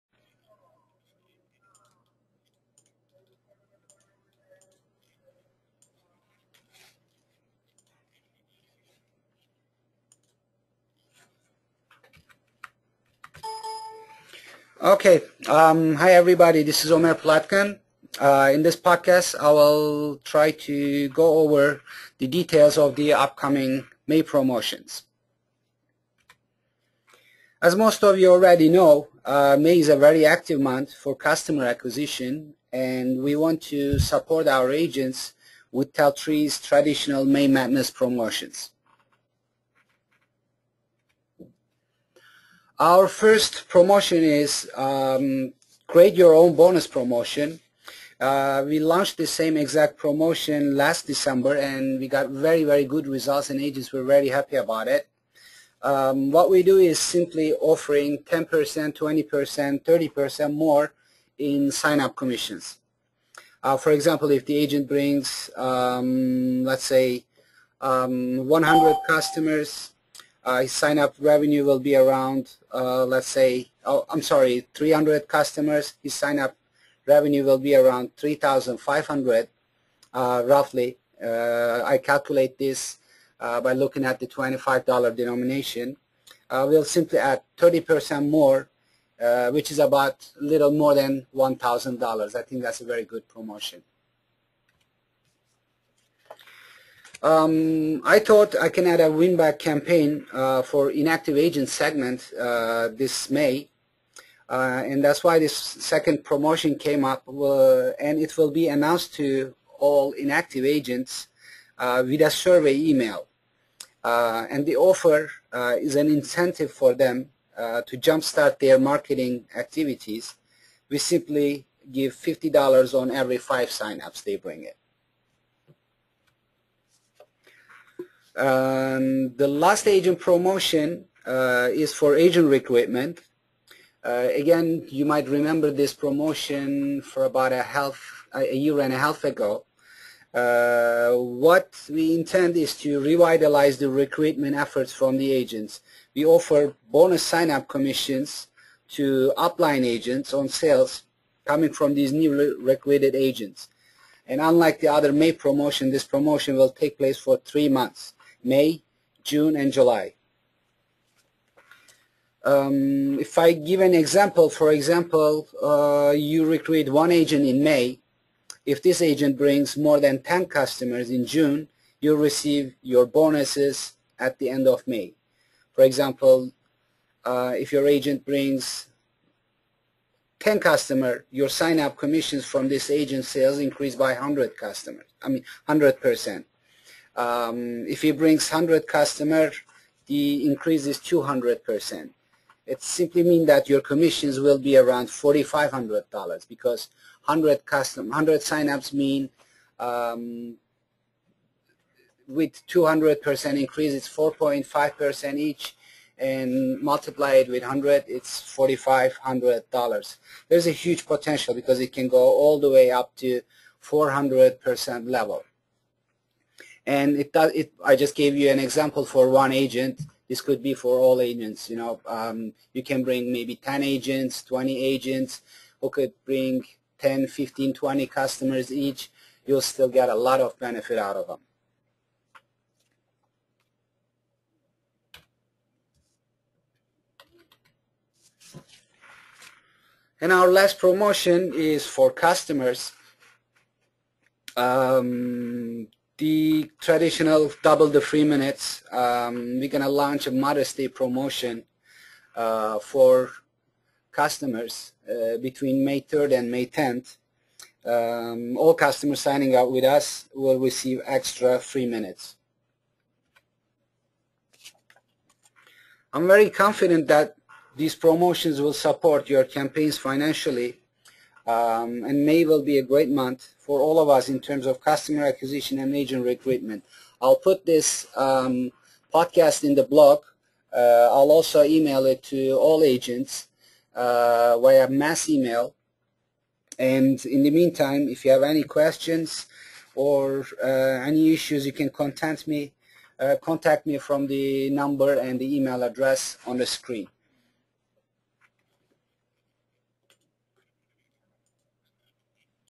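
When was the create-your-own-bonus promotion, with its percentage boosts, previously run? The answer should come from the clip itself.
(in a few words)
last December.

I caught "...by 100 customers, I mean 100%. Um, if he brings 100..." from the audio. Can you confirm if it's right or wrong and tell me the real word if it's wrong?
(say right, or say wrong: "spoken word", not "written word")
right.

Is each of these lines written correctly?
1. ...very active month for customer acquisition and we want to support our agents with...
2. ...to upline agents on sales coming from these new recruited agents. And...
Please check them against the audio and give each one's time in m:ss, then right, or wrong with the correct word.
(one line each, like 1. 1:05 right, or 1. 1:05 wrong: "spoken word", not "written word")
1. 0:29 right
2. 2:28 right.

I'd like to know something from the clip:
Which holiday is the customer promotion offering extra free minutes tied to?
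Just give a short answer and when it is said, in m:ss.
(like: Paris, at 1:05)
Mother's Day, at 4:10.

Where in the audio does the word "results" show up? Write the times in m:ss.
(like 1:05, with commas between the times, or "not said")
0:53.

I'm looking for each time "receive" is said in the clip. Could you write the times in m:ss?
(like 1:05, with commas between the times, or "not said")
2:52, 4:20.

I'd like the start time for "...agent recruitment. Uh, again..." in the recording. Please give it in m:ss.
2:12.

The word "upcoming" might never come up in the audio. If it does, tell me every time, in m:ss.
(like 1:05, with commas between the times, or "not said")
0:23.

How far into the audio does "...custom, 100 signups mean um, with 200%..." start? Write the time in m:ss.
3:17.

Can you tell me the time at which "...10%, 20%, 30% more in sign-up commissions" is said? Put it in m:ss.
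0:58.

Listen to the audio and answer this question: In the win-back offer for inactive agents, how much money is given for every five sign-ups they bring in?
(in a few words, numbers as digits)
$50.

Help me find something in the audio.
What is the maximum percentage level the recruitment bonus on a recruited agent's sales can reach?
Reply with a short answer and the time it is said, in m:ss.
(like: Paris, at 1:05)
400%, at 3:33.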